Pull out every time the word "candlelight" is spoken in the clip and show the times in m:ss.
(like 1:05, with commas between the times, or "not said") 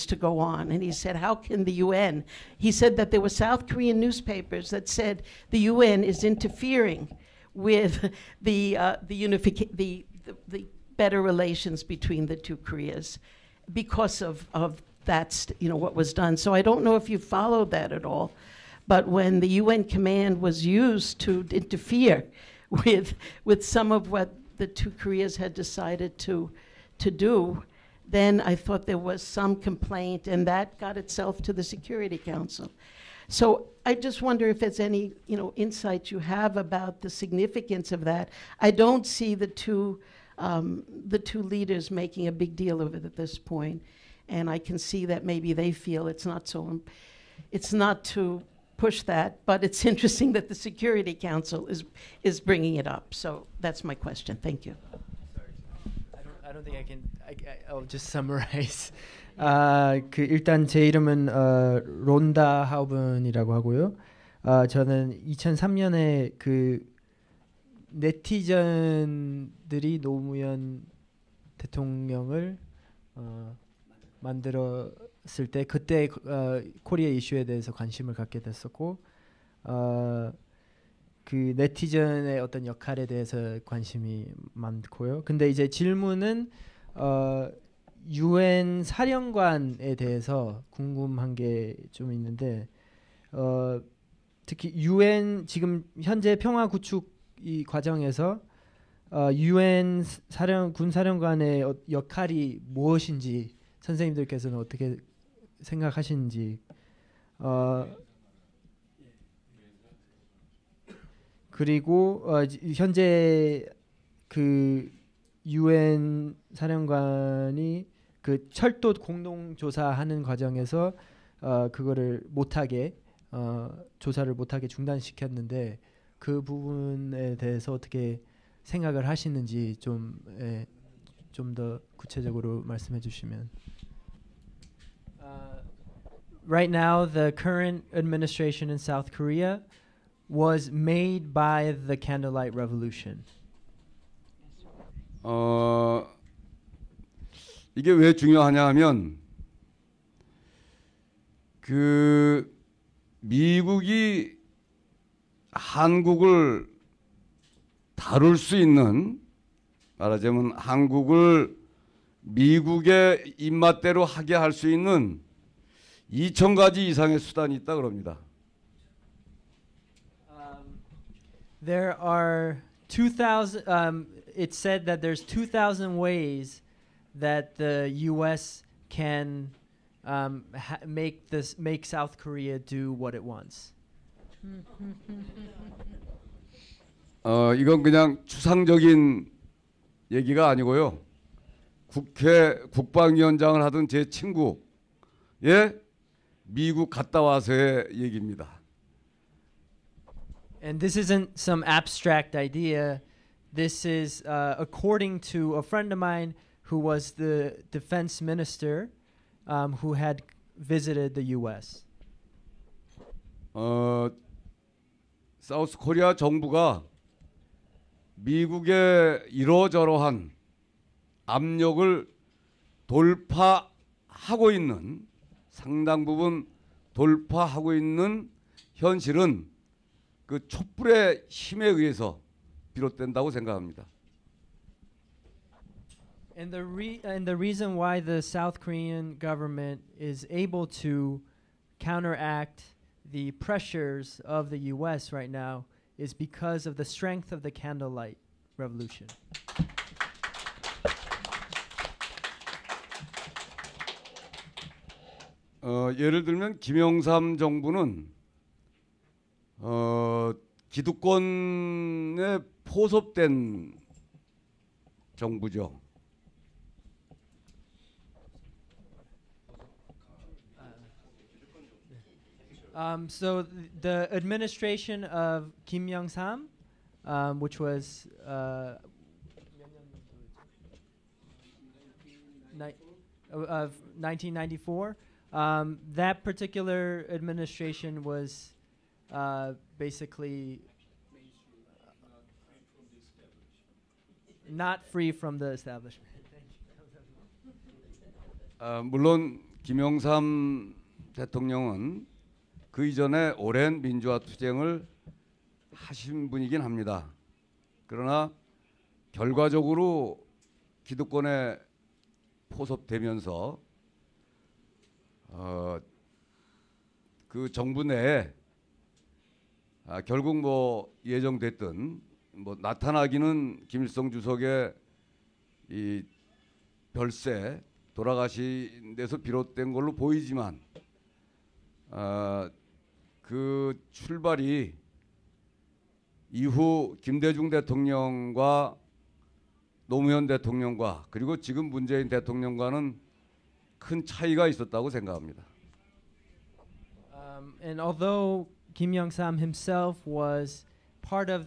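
2:21, 4:07.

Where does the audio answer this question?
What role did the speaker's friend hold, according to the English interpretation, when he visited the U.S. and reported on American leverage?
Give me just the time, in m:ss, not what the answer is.
3:27.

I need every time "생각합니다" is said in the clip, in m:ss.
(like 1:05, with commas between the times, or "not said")
3:53, 5:44.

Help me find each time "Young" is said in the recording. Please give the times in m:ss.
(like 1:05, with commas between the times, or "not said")
4:35, 5:48.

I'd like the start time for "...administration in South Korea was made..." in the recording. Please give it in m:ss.
2:17.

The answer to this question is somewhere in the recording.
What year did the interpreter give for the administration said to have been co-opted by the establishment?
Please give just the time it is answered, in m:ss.
4:43.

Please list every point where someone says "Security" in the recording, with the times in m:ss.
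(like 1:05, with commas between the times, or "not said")
0:31, 0:50.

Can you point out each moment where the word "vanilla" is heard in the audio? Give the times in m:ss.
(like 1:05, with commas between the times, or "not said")
not said.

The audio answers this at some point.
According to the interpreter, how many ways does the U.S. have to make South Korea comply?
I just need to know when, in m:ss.
2:55.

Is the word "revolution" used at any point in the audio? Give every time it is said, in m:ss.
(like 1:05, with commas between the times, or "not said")
2:22, 4:08.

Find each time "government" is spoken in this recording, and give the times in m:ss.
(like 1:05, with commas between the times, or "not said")
3:59.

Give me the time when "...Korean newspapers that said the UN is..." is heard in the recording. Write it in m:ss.
0:03.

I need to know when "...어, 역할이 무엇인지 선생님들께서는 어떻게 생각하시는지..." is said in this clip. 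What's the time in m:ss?
1:41.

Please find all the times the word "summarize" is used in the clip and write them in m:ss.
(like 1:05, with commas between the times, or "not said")
0:58.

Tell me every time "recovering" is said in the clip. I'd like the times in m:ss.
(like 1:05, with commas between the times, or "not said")
not said.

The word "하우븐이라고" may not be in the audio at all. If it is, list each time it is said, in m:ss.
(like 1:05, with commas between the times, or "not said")
1:02.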